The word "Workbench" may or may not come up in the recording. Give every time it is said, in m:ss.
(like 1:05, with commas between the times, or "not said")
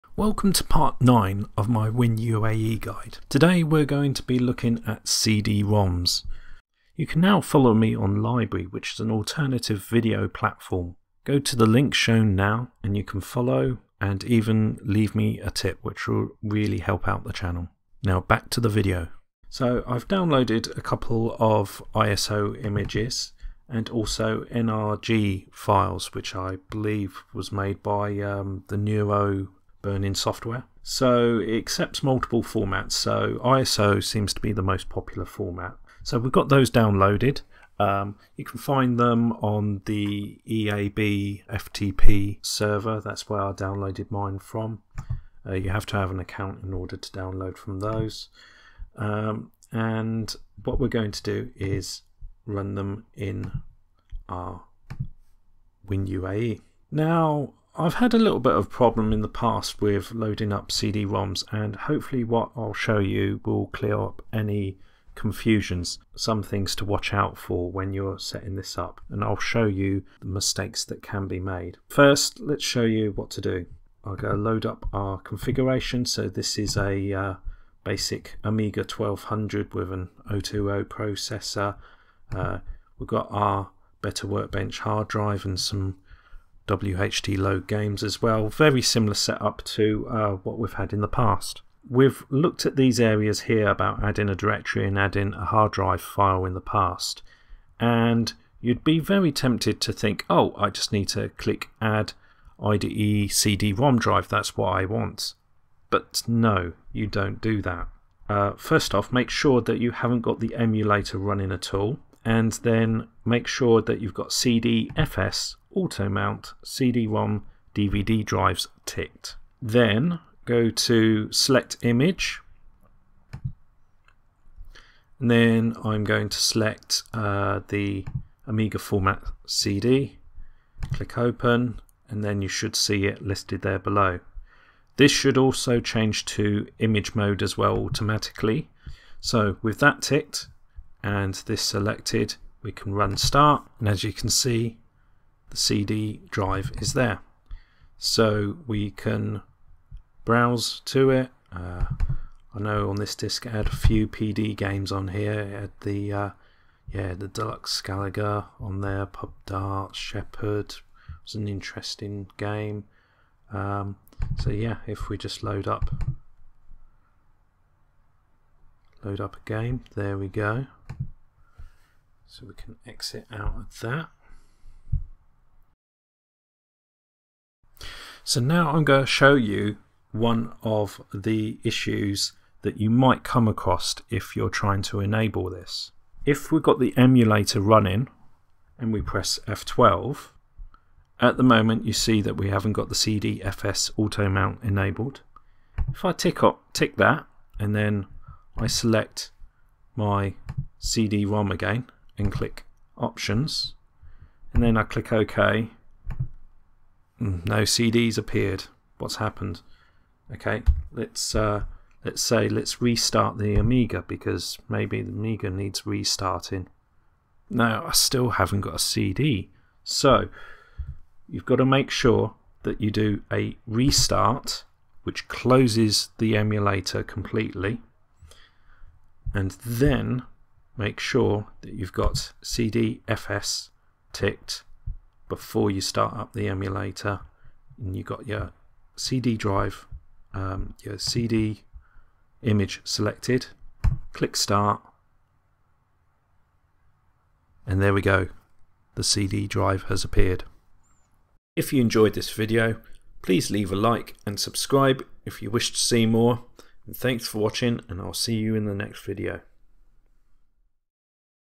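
1:24.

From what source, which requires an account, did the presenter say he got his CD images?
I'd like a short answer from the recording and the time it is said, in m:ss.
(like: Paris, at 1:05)
EAB FTP server, at 0:40.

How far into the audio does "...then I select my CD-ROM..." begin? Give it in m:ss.
3:17.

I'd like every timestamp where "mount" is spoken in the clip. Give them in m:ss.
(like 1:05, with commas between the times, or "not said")
1:56, 3:14.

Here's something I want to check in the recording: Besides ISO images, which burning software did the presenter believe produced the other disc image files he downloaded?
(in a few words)
Nero Burning.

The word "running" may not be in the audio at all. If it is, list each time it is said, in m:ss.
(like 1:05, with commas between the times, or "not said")
1:51, 3:07.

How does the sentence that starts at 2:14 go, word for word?
This should also change to image mode as well automatically.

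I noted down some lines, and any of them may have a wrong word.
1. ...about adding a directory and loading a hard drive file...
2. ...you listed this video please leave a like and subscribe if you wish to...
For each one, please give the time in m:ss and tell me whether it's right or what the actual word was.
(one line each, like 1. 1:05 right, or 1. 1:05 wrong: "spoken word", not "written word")
1. 1:33 wrong: "adding", not "loading"
2. 4:11 wrong: "enjoyed", not "listed".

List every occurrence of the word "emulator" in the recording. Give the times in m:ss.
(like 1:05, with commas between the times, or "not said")
1:50, 3:06, 3:46, 3:56.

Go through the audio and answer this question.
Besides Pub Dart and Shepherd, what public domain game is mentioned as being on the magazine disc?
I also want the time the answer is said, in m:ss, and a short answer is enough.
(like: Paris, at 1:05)
Deluxe Galaga, at 2:37.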